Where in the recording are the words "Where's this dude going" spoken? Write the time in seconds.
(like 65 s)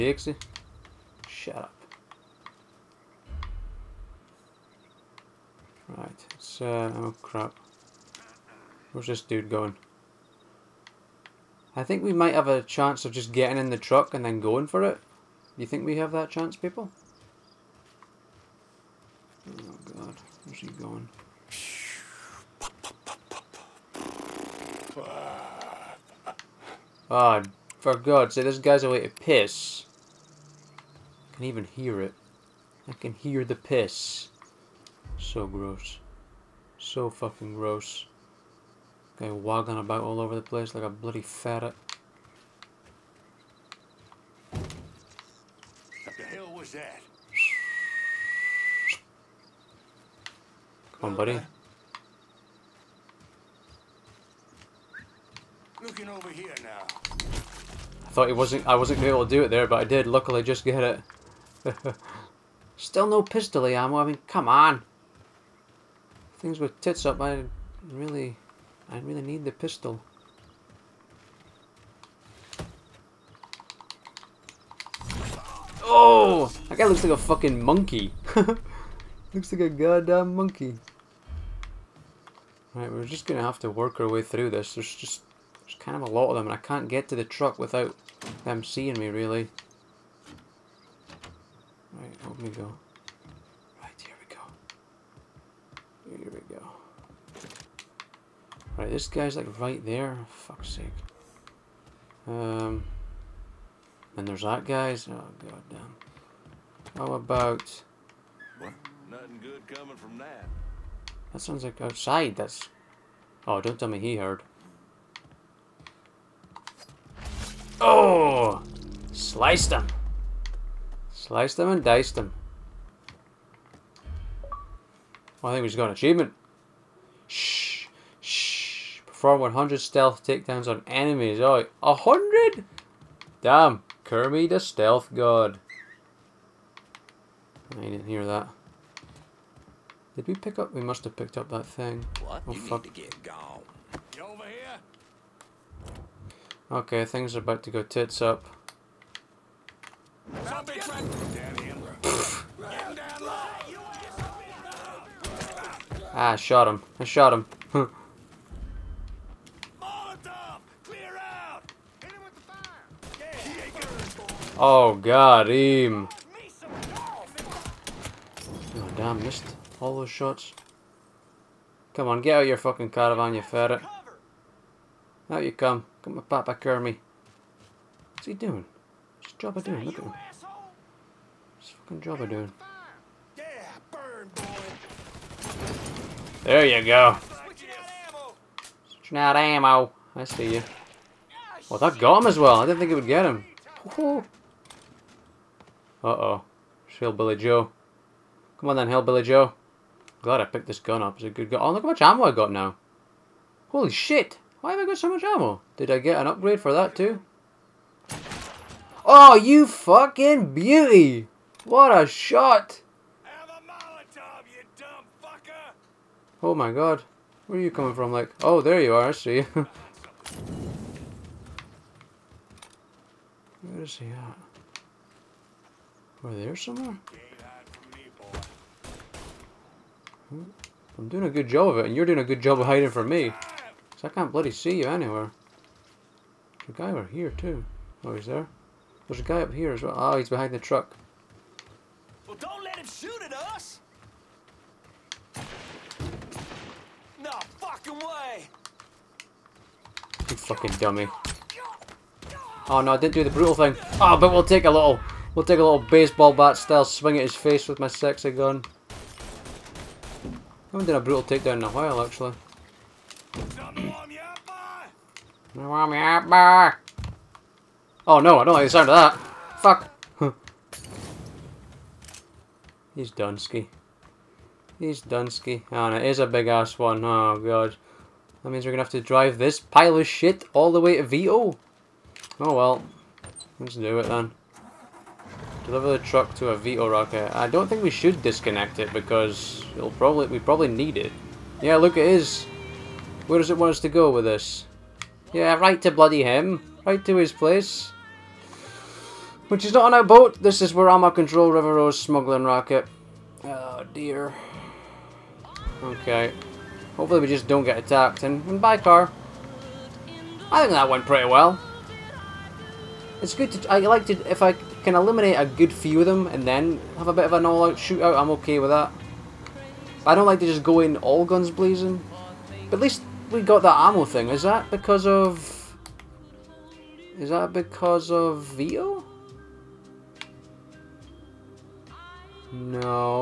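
8 s.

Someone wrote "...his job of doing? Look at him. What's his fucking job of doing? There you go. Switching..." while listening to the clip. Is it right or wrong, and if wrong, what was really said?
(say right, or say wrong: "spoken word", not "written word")
right.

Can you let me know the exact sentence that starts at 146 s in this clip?
Okay, things are about to go tits up.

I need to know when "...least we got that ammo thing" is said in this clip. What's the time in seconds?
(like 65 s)
322 s.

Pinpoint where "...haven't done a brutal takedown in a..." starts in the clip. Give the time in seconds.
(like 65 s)
260 s.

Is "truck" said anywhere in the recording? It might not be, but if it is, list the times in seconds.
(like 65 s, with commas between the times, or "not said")
13 s, 87 s, 240 s, 285 s.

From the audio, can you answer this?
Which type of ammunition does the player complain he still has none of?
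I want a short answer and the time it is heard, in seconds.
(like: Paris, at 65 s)
Pistol ammo, at 63 s.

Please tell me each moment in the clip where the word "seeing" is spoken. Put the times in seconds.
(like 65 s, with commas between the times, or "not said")
88 s.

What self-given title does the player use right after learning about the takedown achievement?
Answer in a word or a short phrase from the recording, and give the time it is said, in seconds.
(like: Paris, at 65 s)
Kirby the Stealth God, at 134 s.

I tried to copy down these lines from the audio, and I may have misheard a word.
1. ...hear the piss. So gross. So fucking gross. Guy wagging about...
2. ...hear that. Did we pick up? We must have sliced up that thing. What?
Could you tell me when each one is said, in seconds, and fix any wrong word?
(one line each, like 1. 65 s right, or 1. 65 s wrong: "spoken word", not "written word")
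1. 33 s right
2. 138 s wrong: "picked", not "sliced".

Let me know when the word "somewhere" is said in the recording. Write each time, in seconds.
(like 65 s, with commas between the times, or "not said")
226 s.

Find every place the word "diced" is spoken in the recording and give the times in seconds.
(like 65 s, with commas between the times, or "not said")
121 s.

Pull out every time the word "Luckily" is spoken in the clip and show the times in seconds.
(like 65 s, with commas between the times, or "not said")
60 s.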